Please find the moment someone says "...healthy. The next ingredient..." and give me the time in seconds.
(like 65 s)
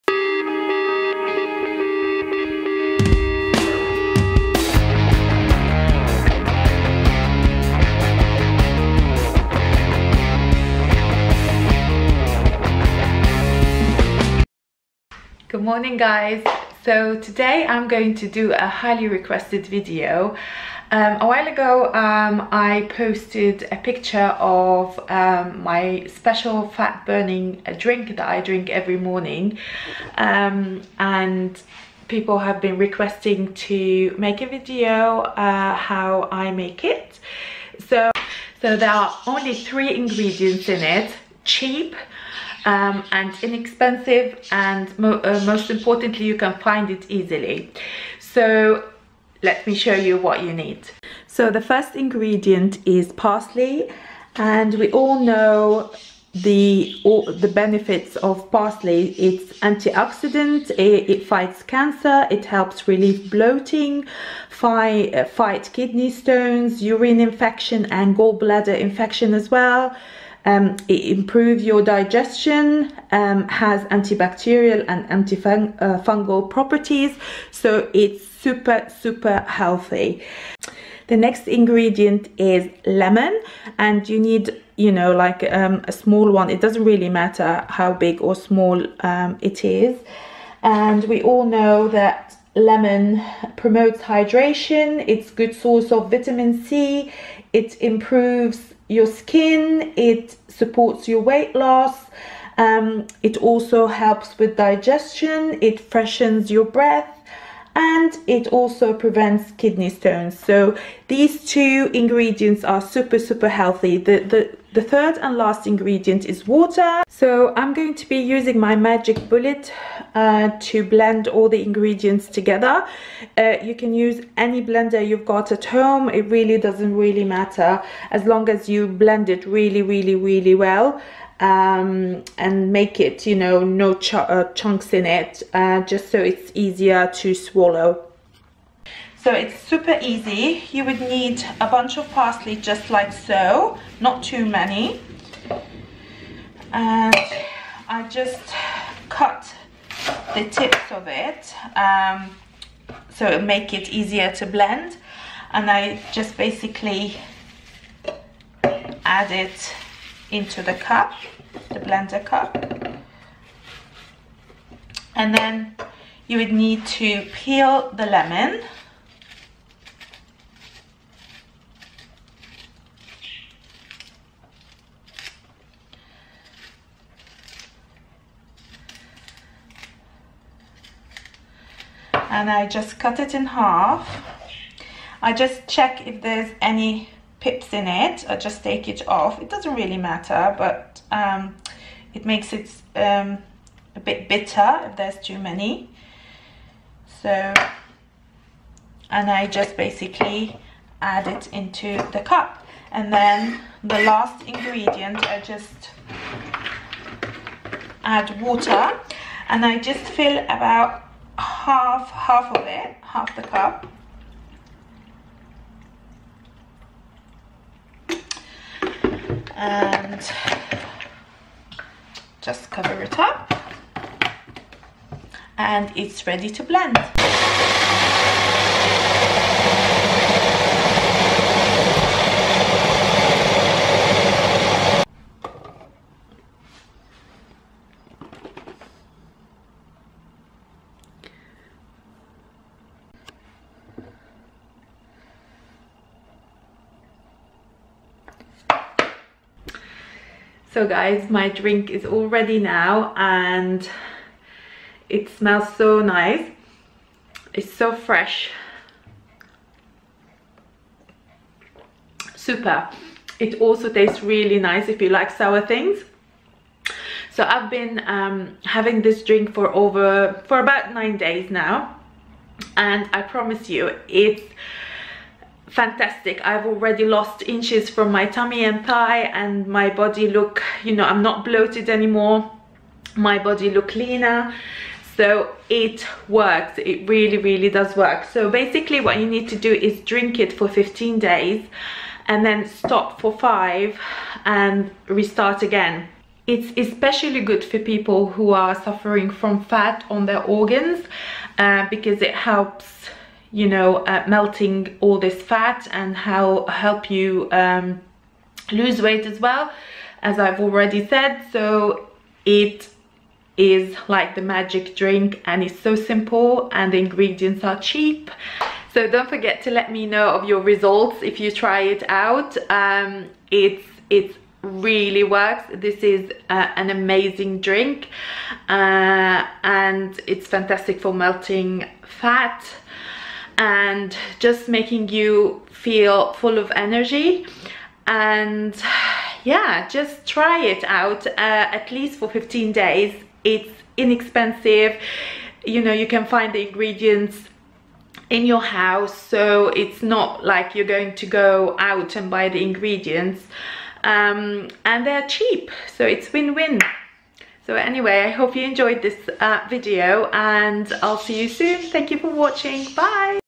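79 s.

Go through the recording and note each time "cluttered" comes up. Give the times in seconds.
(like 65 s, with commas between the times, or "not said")
not said.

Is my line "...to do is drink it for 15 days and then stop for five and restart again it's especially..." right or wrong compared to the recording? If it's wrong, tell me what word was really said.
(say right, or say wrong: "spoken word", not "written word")
right.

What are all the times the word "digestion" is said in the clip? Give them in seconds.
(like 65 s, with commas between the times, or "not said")
71 s, 104 s.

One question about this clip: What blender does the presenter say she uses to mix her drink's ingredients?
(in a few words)
Magic Bullet.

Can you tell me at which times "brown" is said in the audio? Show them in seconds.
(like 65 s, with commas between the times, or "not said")
not said.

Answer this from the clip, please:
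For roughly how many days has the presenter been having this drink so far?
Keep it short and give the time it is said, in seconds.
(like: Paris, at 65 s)
9, at 270 s.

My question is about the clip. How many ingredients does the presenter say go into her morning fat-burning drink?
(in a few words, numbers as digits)
3.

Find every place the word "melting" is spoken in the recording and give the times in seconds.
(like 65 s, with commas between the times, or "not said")
304 s, 331 s.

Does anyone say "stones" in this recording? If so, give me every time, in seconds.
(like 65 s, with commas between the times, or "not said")
66 s, 109 s.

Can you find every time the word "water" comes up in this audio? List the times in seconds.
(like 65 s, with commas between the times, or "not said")
116 s, 208 s.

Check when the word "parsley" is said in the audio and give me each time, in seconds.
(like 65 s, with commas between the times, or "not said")
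53 s, 58 s, 142 s.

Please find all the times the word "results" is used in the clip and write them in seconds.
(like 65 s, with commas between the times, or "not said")
320 s.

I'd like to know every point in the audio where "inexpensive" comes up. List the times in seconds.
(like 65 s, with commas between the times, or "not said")
43 s, 343 s.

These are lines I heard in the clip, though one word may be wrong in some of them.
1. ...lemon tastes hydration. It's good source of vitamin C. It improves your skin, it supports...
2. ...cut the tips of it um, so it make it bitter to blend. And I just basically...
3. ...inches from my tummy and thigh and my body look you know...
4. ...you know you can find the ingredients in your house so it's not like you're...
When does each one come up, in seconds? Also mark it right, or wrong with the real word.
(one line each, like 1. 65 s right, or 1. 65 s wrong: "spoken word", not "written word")
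1. 92 s wrong: "promotes", not "tastes"
2. 149 s wrong: "easier", not "bitter"
3. 277 s right
4. 345 s right.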